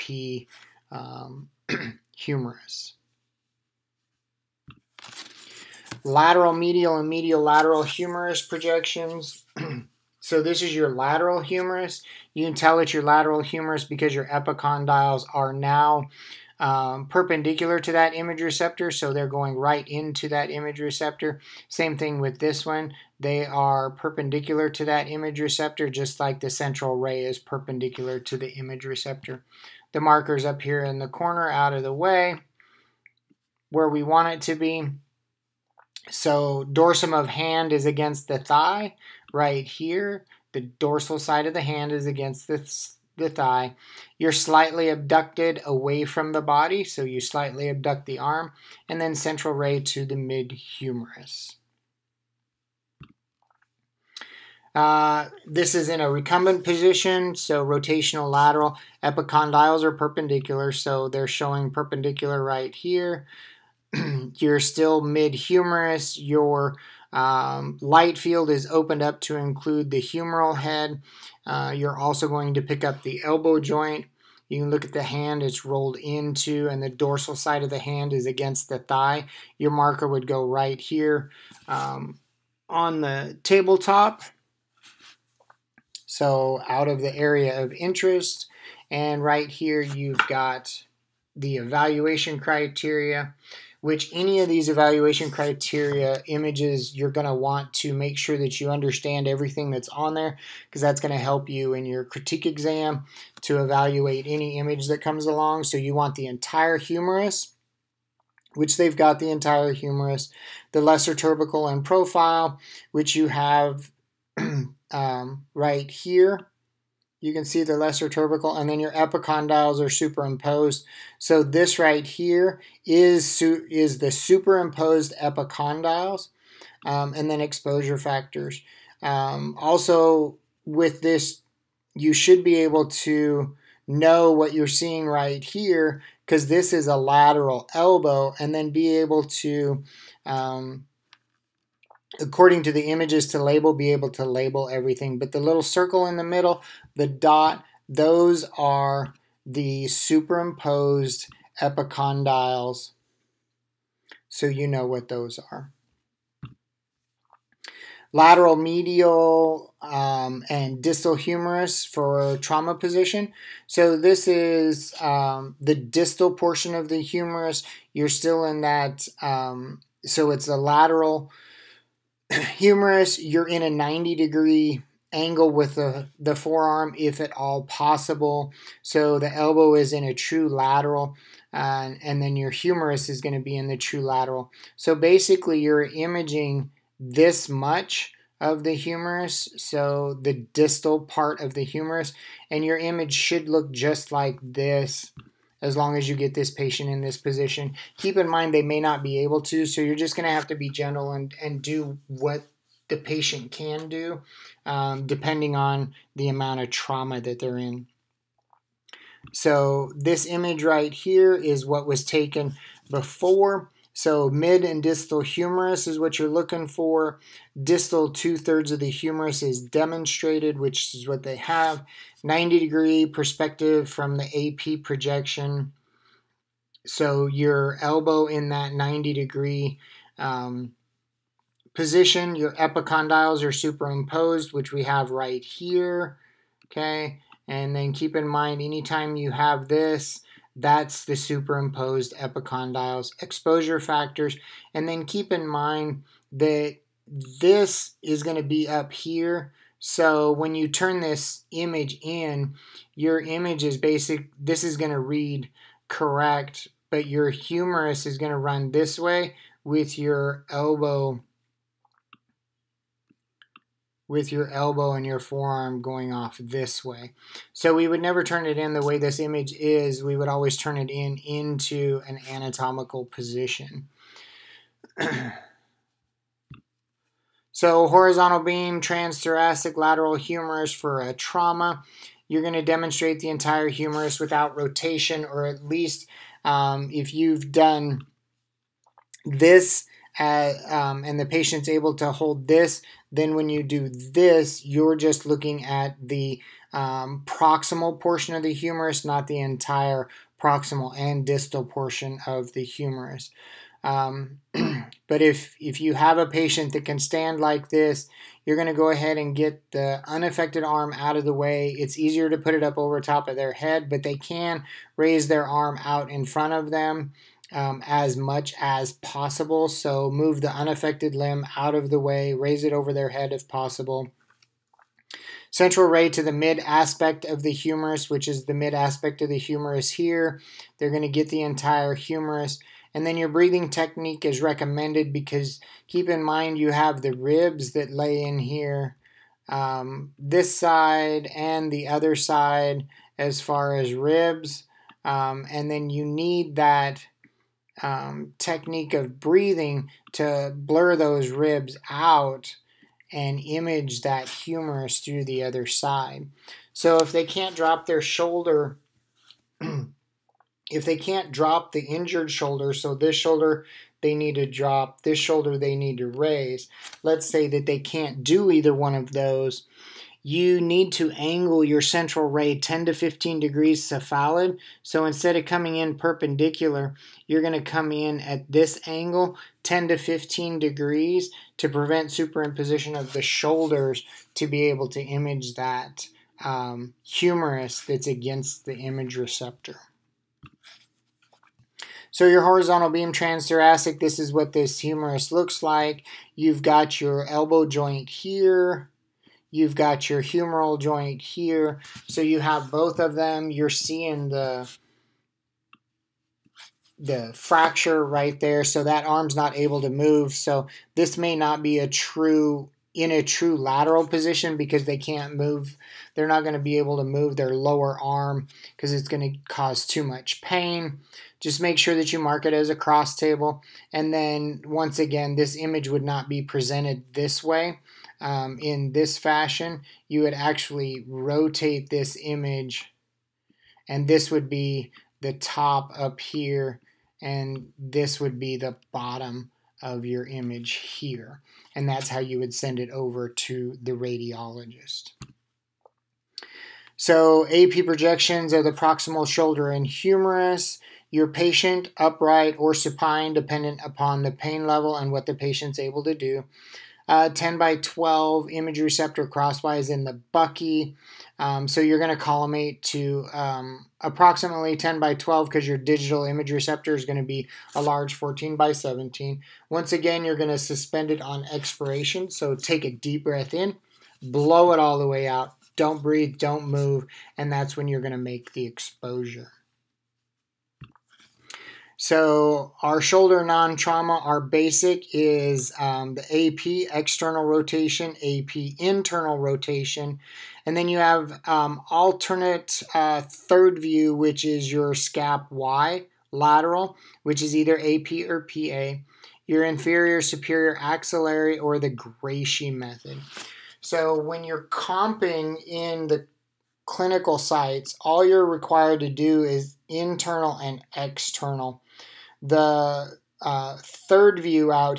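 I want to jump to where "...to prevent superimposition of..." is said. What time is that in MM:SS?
06:21.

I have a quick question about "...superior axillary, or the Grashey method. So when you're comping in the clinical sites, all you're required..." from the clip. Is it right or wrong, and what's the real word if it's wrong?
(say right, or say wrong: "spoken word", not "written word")
right.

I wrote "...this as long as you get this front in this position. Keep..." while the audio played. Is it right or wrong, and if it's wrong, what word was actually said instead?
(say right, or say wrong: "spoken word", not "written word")
wrong: "patient", not "front".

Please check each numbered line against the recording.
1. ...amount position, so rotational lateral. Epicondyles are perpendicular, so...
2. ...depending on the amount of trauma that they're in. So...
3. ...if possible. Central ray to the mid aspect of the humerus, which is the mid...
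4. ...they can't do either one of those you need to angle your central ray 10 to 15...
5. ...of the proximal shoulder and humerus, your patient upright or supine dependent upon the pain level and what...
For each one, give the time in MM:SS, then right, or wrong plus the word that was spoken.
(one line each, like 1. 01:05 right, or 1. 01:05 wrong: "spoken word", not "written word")
1. 00:56 wrong: "recumbent", not "amount"
2. 03:25 right
3. 05:23 right
4. 06:07 right
5. 07:28 right.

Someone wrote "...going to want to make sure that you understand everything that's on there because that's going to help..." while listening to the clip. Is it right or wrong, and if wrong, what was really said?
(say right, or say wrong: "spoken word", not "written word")
right.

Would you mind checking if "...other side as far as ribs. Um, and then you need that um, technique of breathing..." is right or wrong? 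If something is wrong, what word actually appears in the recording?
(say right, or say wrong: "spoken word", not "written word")
right.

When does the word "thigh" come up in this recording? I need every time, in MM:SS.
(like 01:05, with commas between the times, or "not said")
00:38, 00:43, 01:18.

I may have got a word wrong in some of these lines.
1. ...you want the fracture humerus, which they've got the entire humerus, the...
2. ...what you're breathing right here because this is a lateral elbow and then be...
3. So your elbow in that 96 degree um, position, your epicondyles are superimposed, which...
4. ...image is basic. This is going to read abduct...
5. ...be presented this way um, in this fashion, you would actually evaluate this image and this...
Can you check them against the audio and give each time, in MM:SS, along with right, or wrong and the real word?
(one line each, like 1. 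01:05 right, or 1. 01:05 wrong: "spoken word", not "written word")
1. 01:45 wrong: "entire", not "fracture"
2. 02:14 wrong: "seeing", not "breathing"
3. 03:46 wrong: "90", not "96"
4. 04:13 wrong: "correct", not "abduct"
5. 07:06 wrong: "rotate", not "evaluate".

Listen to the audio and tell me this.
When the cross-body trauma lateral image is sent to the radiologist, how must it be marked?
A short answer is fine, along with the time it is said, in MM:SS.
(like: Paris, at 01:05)
Cross table, at 07:02.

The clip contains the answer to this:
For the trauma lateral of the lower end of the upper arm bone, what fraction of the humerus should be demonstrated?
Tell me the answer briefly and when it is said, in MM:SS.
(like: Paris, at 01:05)
Distal two-thirds, at 03:37.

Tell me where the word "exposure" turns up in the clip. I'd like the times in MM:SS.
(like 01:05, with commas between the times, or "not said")
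02:07, 04:03, 07:58.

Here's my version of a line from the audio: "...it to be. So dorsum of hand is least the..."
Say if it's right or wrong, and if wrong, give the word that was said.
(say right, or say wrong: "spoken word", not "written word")
wrong: "against", not "least".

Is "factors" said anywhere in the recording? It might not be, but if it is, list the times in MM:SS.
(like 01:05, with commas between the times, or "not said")
02:07, 04:03.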